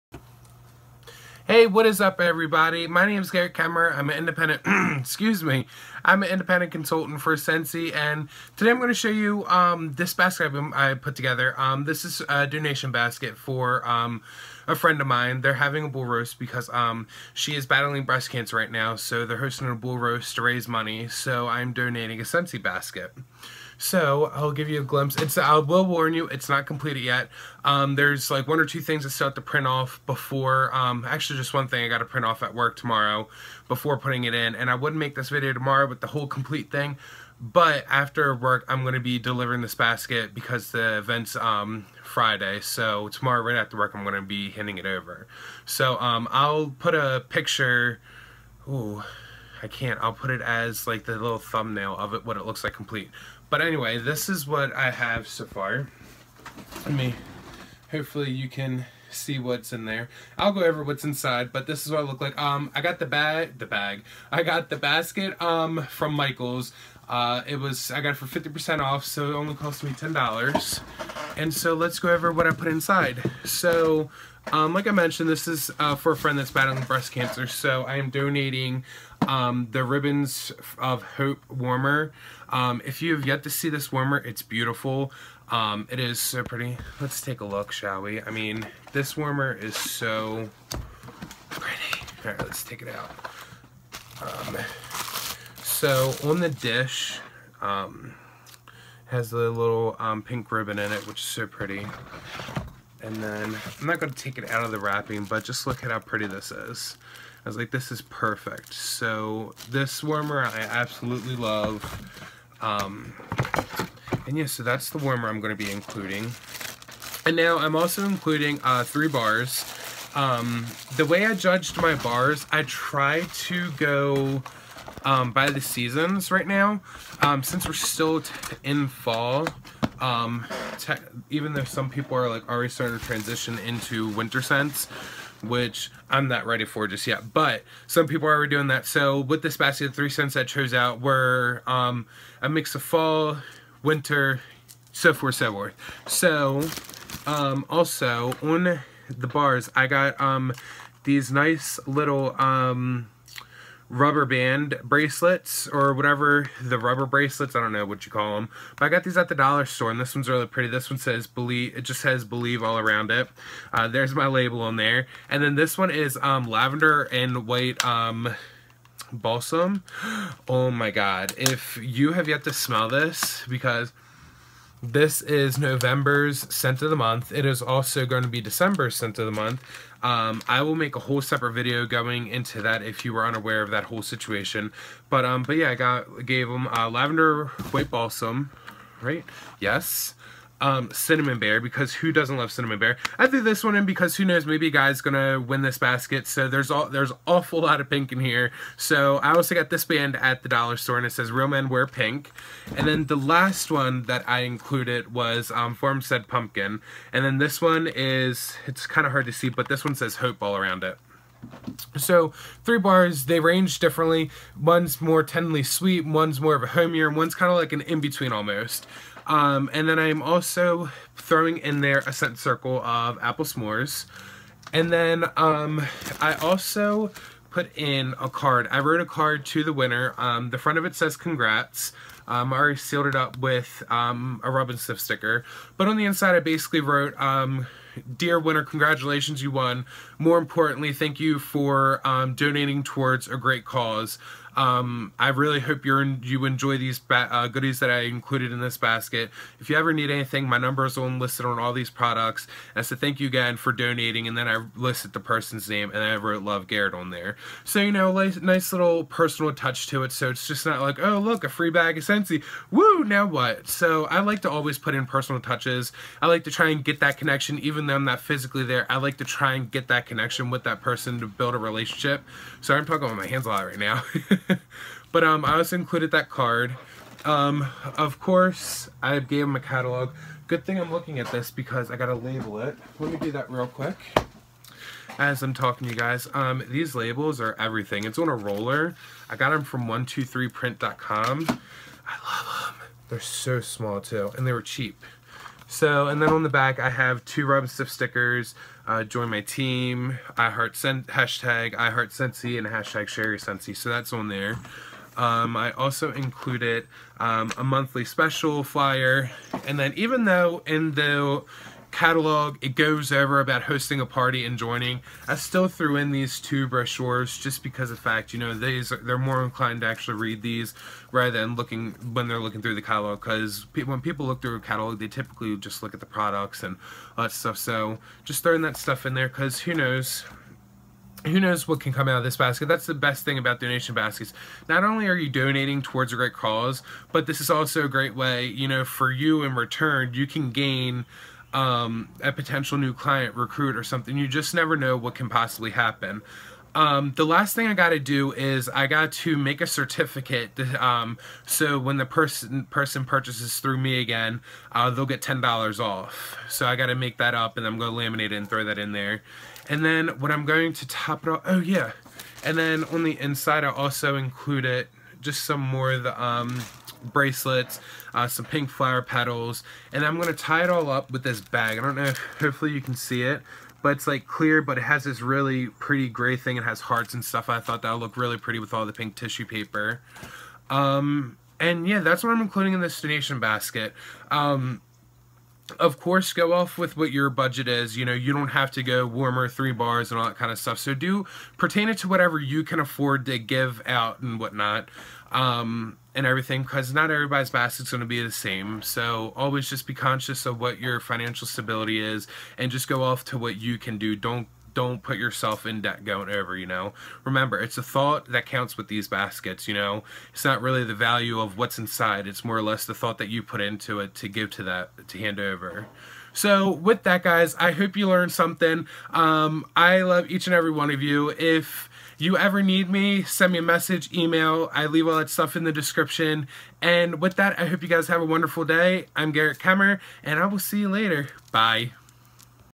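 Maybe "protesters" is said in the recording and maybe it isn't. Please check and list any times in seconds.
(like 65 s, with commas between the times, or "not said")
not said.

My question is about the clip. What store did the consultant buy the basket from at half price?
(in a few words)
Michaels.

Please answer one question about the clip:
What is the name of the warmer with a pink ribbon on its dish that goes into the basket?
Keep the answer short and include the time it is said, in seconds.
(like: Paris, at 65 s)
Ribbons of Hope, at 79 s.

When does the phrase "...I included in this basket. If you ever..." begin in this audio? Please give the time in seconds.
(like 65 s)
247 s.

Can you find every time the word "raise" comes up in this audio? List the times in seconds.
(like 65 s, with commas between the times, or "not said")
20 s.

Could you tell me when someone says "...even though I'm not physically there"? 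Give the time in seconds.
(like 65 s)
267 s.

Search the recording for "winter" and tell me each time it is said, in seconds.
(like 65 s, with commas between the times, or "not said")
134 s, 143 s.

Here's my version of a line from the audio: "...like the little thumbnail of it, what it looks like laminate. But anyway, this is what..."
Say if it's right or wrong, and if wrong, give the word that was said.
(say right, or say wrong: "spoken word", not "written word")
wrong: "complete", not "laminate".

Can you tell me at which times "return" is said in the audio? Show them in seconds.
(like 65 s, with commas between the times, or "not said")
339 s.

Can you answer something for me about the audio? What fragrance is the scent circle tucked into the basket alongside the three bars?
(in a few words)
apple s'mores.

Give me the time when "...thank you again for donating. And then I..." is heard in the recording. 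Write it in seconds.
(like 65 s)
252 s.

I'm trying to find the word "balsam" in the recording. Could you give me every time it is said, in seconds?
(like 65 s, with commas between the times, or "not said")
169 s, 187 s.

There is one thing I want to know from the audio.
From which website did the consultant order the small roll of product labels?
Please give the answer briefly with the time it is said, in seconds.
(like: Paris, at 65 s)
123print.com, at 289 s.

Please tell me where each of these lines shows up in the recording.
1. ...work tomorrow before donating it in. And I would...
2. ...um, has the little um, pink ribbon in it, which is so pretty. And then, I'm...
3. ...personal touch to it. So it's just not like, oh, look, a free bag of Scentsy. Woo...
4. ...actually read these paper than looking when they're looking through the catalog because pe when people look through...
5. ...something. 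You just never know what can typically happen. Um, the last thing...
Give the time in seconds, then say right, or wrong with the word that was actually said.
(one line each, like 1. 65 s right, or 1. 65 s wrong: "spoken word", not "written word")
1. 32 s wrong: "putting", not "donating"
2. 97 s right
3. 259 s right
4. 319 s wrong: "rather", not "paper"
5. 343 s wrong: "possibly", not "typically".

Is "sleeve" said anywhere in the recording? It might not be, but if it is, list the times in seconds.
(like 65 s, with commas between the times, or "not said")
not said.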